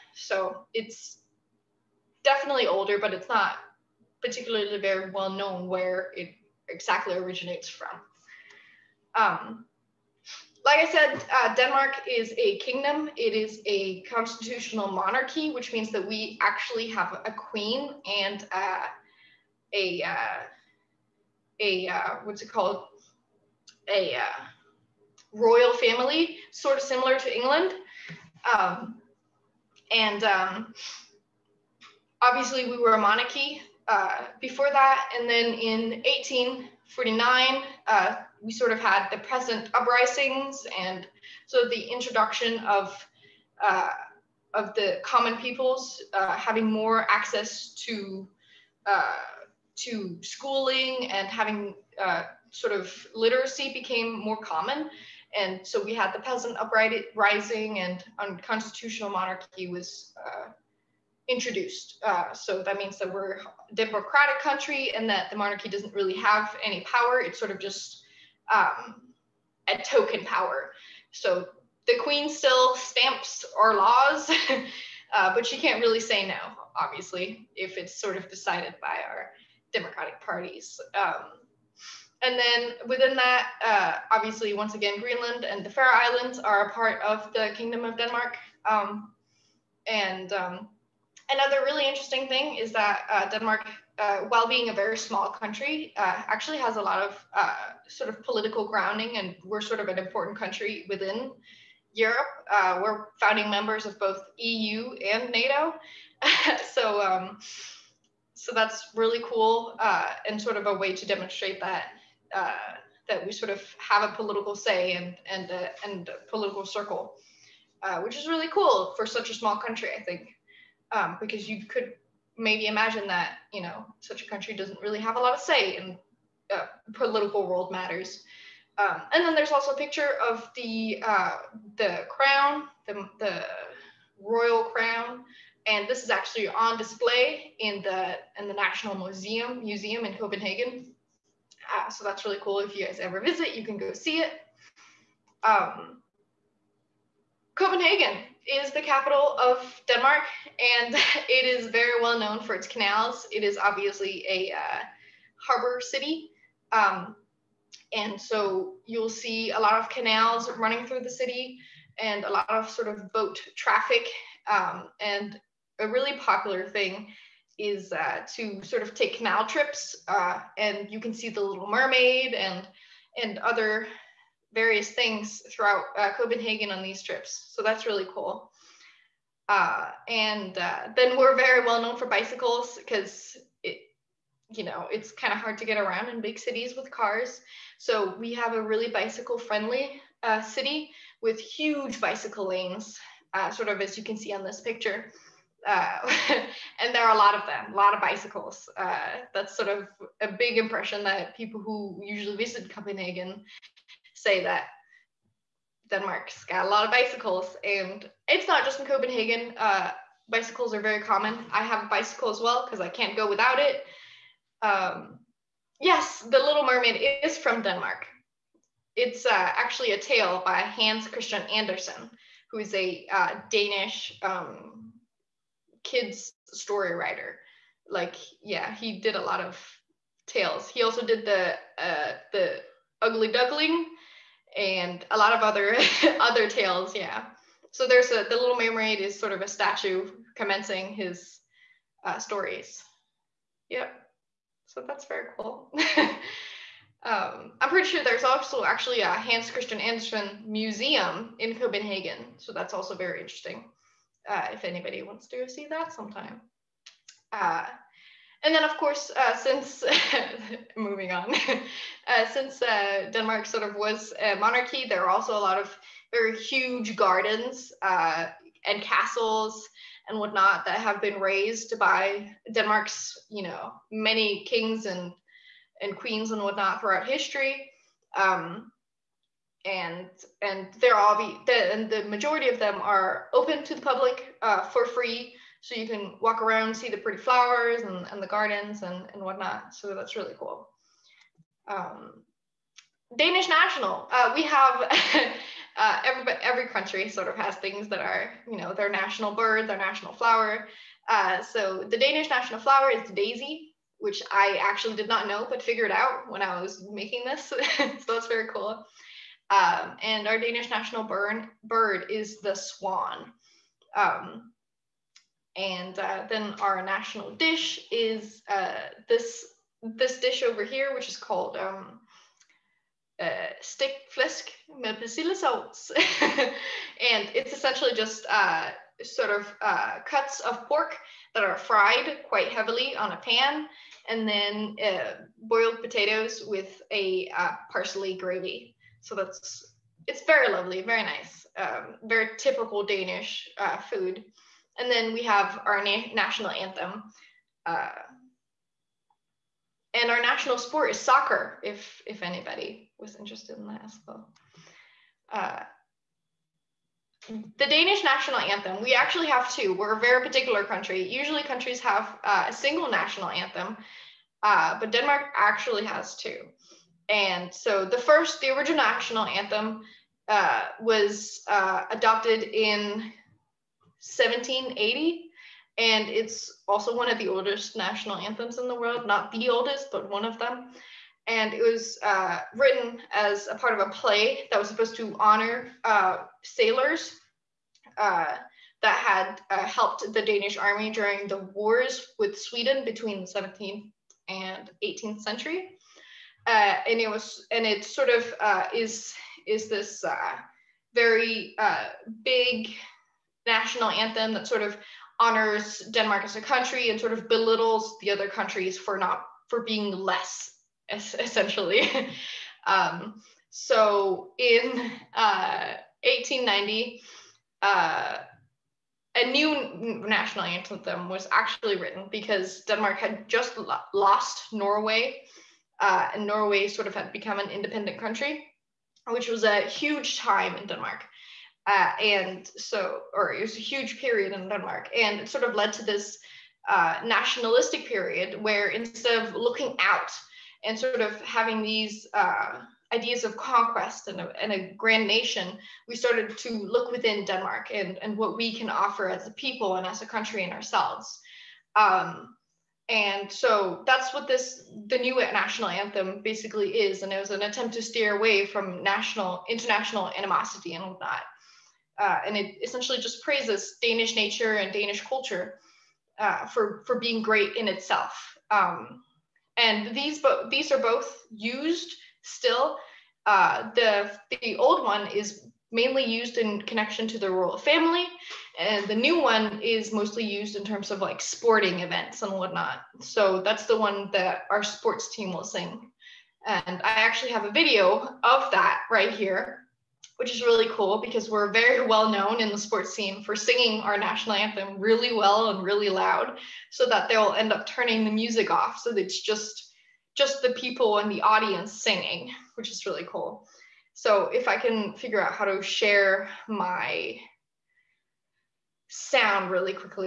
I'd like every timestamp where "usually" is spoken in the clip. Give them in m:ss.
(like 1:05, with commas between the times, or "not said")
3:22, 6:01.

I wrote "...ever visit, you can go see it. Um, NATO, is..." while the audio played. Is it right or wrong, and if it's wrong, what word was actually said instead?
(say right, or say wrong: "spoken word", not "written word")
wrong: "Copenhagen", not "NATO".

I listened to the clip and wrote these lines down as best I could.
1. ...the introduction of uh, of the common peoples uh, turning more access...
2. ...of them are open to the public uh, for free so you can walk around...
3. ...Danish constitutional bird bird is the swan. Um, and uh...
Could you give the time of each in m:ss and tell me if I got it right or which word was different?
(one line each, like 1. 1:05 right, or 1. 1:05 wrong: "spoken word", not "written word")
1. 0:41 wrong: "having", not "turning"
2. 4:42 right
3. 5:10 wrong: "national", not "constitutional".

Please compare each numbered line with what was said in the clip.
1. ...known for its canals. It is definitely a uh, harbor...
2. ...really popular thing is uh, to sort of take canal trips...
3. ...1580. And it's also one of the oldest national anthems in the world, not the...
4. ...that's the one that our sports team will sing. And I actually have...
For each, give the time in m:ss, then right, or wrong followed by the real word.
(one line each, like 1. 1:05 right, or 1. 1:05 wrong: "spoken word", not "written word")
1. 2:32 wrong: "obviously", not "definitely"
2. 2:45 right
3. 6:14 wrong: "1780", not "1580"
4. 8:03 right.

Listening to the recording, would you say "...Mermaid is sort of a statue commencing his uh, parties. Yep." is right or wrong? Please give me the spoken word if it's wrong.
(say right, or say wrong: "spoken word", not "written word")
wrong: "stories", not "parties".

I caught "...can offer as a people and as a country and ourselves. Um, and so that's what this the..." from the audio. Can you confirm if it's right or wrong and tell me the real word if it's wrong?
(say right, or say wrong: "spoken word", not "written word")
right.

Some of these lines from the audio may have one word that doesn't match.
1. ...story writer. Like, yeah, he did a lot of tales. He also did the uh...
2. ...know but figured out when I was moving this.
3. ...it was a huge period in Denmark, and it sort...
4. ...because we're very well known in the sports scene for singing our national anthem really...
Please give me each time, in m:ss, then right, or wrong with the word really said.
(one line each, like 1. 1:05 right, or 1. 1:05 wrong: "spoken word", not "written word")
1. 3:46 right
2. 5:05 wrong: "making", not "moving"
3. 7:13 right
4. 8:11 right.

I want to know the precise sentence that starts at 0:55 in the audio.
And so we had the peasant uprising and unconstitutional monarchy was uh, introduced.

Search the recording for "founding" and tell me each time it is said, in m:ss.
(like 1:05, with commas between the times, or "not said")
1:43.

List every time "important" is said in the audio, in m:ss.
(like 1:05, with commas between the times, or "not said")
1:39.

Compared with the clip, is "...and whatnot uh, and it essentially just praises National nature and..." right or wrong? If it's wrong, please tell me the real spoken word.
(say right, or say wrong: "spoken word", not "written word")
wrong: "Danish", not "National".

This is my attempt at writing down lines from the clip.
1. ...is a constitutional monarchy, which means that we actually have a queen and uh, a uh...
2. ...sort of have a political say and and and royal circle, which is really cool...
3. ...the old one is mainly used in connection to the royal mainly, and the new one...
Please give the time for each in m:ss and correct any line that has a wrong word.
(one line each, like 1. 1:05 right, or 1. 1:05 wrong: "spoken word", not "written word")
1. 0:13 right
2. 1:53 wrong: "political", not "royal"
3. 7:54 wrong: "family", not "mainly".